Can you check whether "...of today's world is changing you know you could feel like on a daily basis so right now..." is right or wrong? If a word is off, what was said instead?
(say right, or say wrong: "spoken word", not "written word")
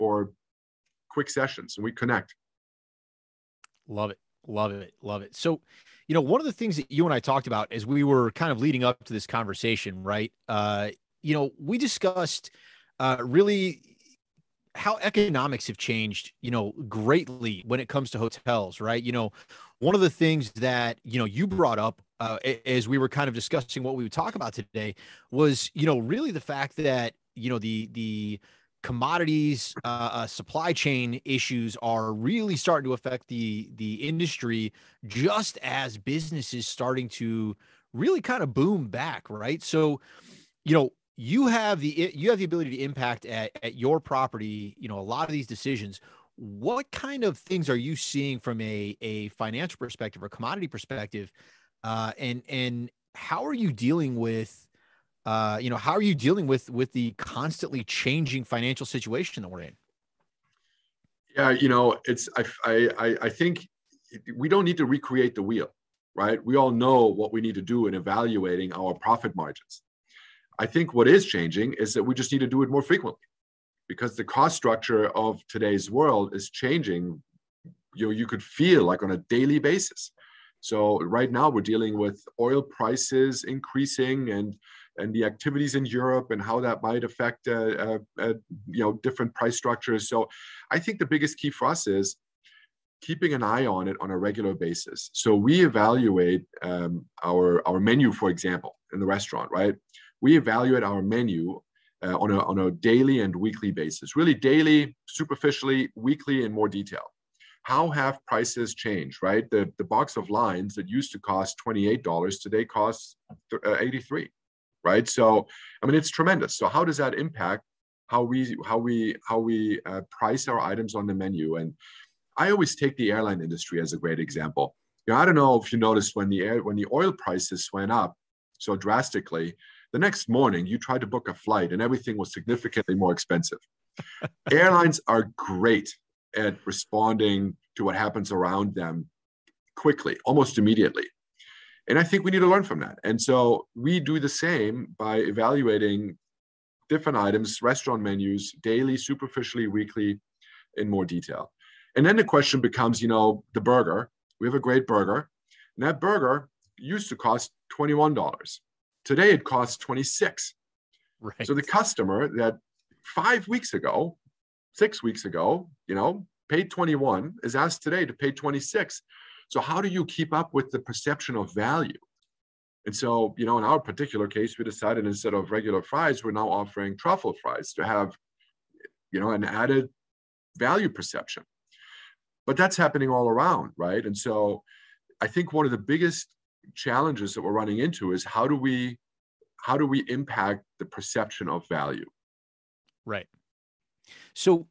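right.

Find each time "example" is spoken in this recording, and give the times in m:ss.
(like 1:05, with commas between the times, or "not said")
1:38, 2:04.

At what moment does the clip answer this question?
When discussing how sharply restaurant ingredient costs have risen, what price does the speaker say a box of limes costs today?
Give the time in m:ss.
1:53.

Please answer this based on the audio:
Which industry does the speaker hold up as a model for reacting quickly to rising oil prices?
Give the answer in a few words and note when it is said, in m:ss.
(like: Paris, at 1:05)
airline industry, at 2:03.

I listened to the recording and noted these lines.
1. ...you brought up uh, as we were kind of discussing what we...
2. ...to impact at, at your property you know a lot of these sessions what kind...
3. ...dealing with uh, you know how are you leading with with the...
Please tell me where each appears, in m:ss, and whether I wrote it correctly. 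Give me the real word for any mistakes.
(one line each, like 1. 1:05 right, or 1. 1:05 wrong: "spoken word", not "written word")
1. 0:21 right
2. 0:42 wrong: "decisions", not "sessions"
3. 0:53 wrong: "dealing", not "leading".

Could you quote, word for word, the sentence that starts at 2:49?
So how do you keep up with the perception of value?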